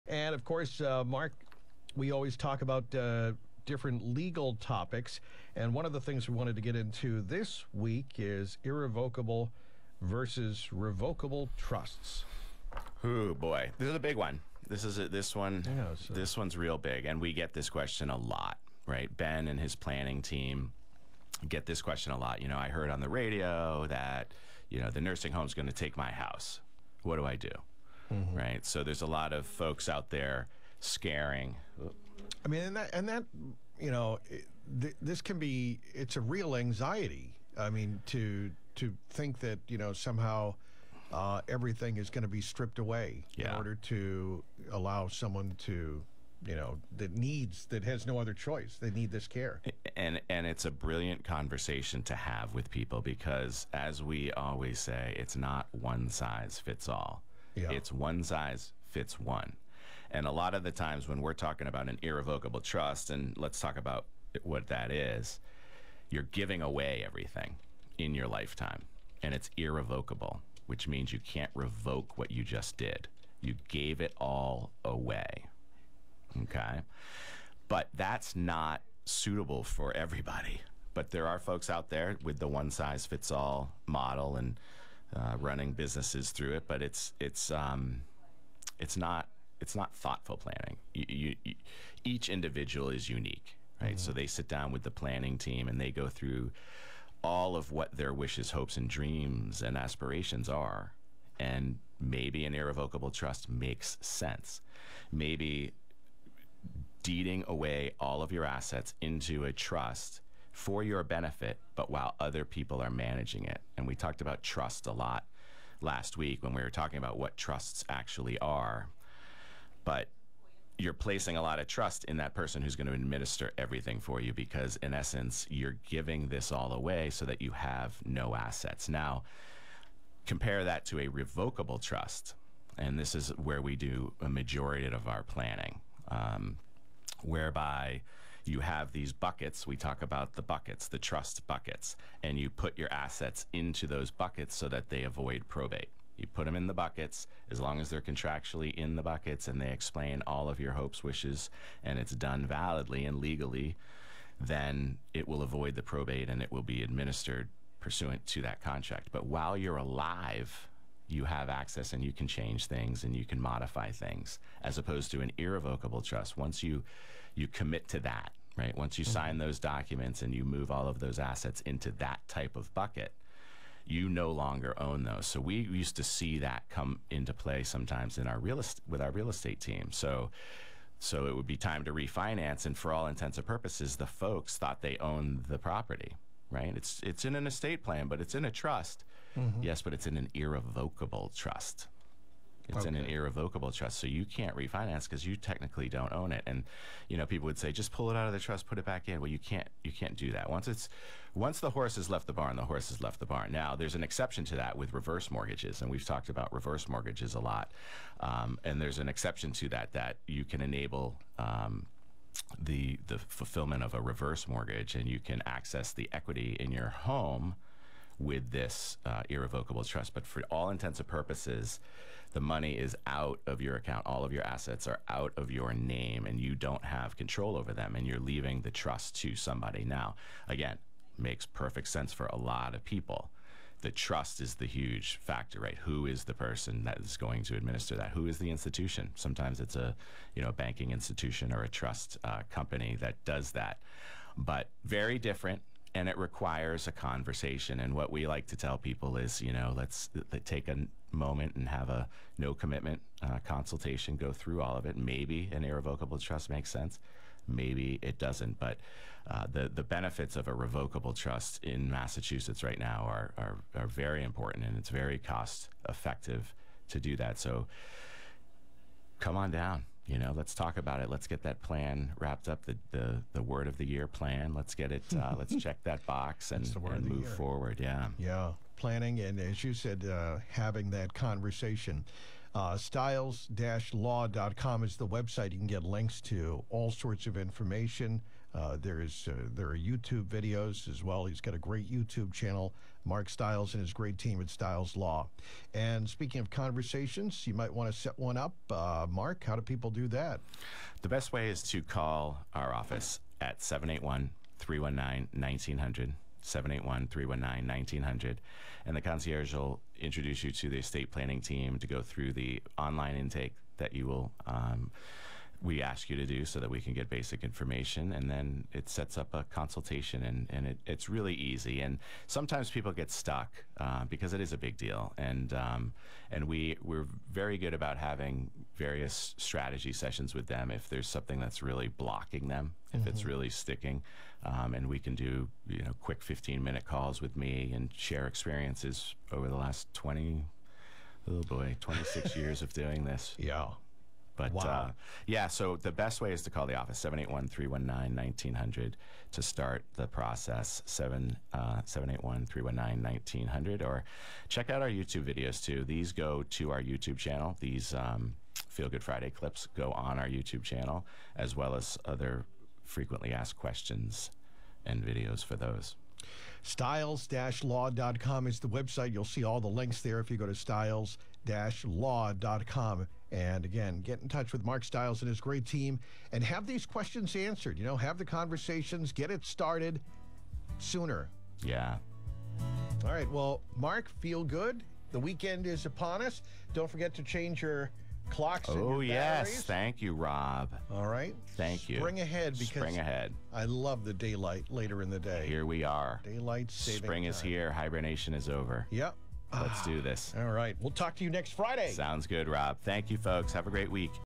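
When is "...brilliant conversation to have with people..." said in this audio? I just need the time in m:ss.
0:50.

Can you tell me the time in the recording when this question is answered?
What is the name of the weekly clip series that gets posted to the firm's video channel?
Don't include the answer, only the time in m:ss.
5:58.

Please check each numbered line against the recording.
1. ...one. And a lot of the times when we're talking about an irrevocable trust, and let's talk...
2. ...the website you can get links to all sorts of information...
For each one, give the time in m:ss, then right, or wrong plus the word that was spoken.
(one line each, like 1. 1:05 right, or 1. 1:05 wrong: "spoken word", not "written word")
1. 0:59 right
2. 4:44 right.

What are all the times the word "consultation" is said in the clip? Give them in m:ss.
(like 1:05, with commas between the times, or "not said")
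4:13, 5:19.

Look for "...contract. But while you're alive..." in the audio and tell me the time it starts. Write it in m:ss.
2:38.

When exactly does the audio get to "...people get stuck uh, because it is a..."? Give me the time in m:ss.
5:22.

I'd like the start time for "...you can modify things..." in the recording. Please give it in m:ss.
2:43.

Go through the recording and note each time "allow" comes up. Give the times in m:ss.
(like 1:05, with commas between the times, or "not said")
0:44.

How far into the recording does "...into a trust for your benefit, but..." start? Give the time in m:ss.
1:49.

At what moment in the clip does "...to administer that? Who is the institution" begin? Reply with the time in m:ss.
3:57.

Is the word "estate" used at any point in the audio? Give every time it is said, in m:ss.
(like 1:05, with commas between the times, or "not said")
2:59, 3:07, 5:10.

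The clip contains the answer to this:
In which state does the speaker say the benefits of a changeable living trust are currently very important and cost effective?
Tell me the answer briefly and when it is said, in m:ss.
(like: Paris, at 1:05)
Massachusetts, at 4:21.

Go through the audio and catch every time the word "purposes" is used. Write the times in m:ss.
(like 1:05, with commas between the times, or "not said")
3:03, 3:41.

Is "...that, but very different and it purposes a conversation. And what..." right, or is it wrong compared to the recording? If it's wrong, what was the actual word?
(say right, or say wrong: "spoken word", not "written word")
wrong: "requires", not "purposes".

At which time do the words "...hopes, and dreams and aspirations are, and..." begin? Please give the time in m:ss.
1:38.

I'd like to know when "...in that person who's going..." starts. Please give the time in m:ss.
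2:02.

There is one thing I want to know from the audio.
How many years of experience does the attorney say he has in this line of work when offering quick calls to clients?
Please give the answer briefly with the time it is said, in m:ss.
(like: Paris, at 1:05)
26, at 5:41.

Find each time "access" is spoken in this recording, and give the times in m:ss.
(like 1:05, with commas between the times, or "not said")
2:41, 3:35.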